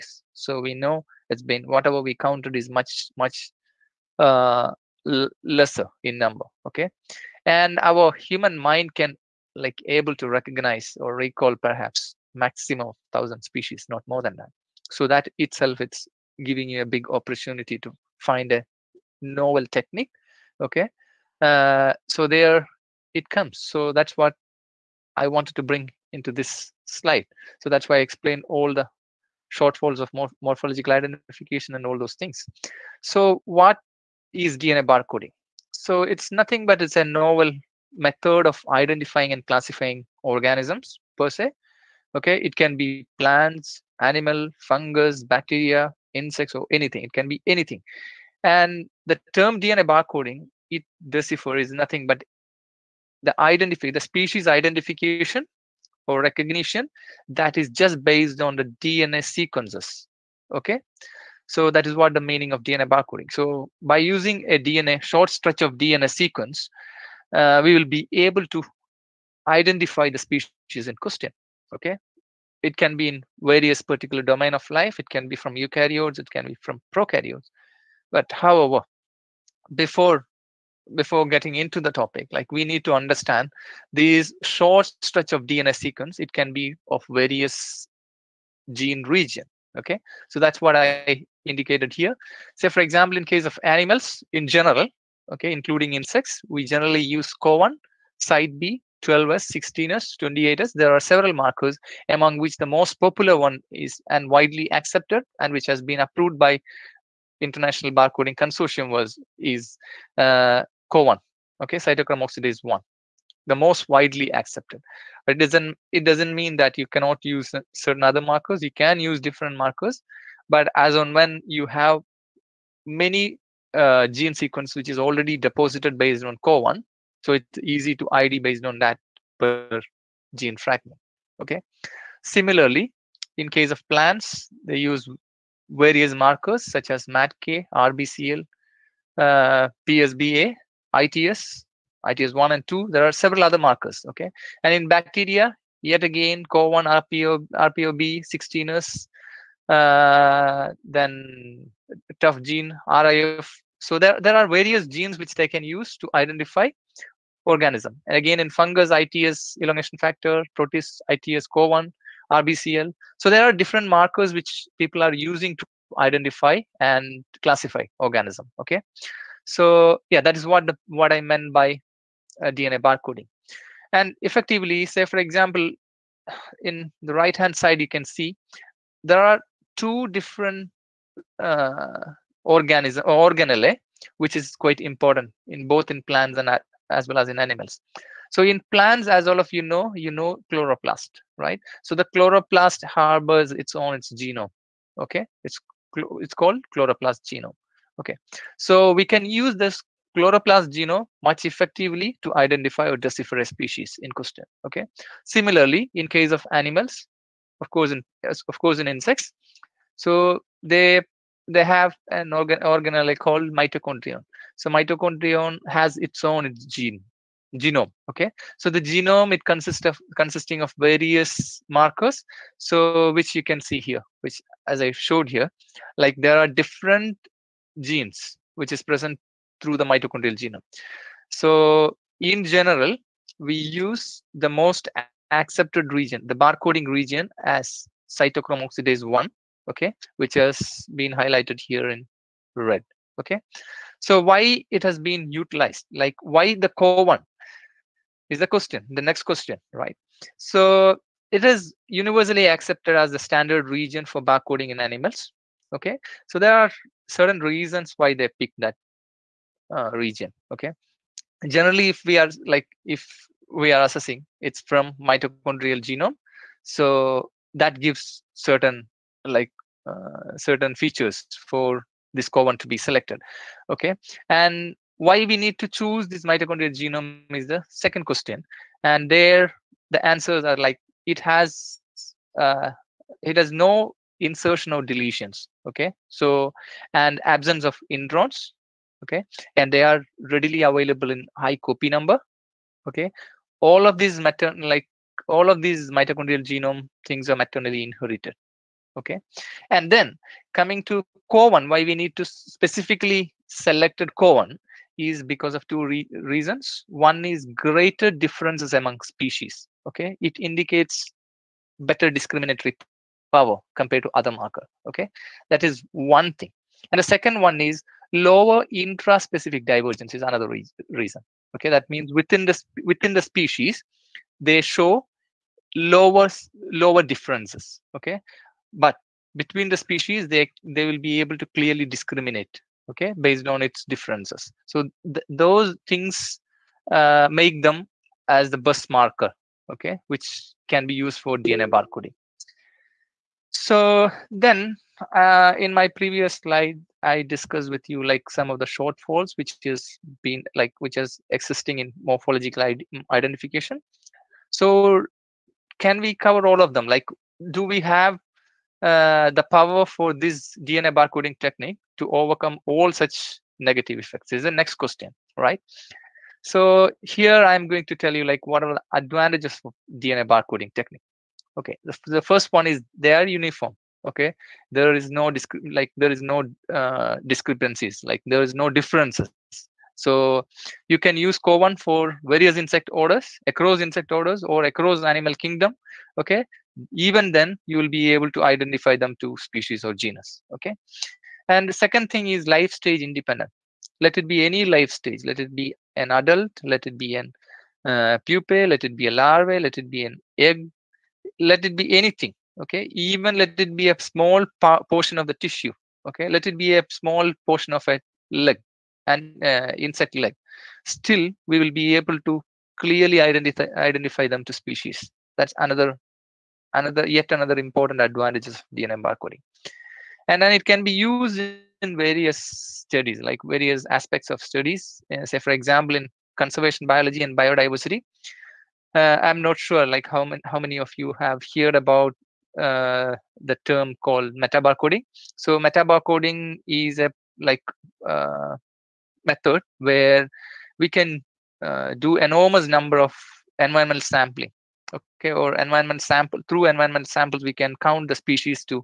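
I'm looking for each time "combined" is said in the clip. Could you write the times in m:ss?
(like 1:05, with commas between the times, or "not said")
not said.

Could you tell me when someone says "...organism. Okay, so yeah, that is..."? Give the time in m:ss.
2:47.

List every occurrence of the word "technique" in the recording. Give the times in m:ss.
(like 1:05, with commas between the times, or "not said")
0:19, 6:01, 6:10.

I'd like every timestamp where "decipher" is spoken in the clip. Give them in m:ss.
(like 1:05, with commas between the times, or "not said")
0:51, 3:22.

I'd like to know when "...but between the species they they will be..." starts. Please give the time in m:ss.
5:28.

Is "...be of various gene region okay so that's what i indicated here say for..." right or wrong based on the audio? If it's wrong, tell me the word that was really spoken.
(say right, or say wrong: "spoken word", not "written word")
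right.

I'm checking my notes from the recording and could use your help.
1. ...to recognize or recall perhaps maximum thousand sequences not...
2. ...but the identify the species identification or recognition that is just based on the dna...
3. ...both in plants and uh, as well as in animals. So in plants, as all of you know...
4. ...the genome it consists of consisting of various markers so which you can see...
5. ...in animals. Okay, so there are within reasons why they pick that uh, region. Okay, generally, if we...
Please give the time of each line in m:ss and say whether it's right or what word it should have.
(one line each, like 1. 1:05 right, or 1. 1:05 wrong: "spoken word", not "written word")
1. 0:10 wrong: "species", not "sequences"
2. 0:52 right
3. 3:05 right
4. 3:38 right
5. 4:14 wrong: "certain", not "within".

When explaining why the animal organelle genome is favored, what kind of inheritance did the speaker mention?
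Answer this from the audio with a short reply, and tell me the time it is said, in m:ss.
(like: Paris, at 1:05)
maternally inherited, at 4:57.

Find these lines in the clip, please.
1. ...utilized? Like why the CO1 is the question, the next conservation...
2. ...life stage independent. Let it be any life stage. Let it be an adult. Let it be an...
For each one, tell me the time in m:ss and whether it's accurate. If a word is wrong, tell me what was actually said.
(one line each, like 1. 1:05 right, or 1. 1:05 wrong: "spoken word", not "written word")
1. 4:05 wrong: "question", not "conservation"
2. 6:32 right.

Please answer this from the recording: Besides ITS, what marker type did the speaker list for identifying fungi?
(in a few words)
elongation factor.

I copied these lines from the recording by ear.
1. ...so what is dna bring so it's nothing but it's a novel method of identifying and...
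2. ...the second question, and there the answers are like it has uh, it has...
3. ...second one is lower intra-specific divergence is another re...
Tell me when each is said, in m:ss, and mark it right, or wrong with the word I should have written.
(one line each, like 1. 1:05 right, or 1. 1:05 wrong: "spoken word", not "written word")
1. 0:33 wrong: "barcoding", not "bring"
2. 4:37 right
3. 5:17 right.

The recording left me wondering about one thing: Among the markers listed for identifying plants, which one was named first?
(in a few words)
MATK.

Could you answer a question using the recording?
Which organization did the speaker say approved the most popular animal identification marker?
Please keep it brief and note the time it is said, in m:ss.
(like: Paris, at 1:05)
International Barcoding Consortium, at 1:47.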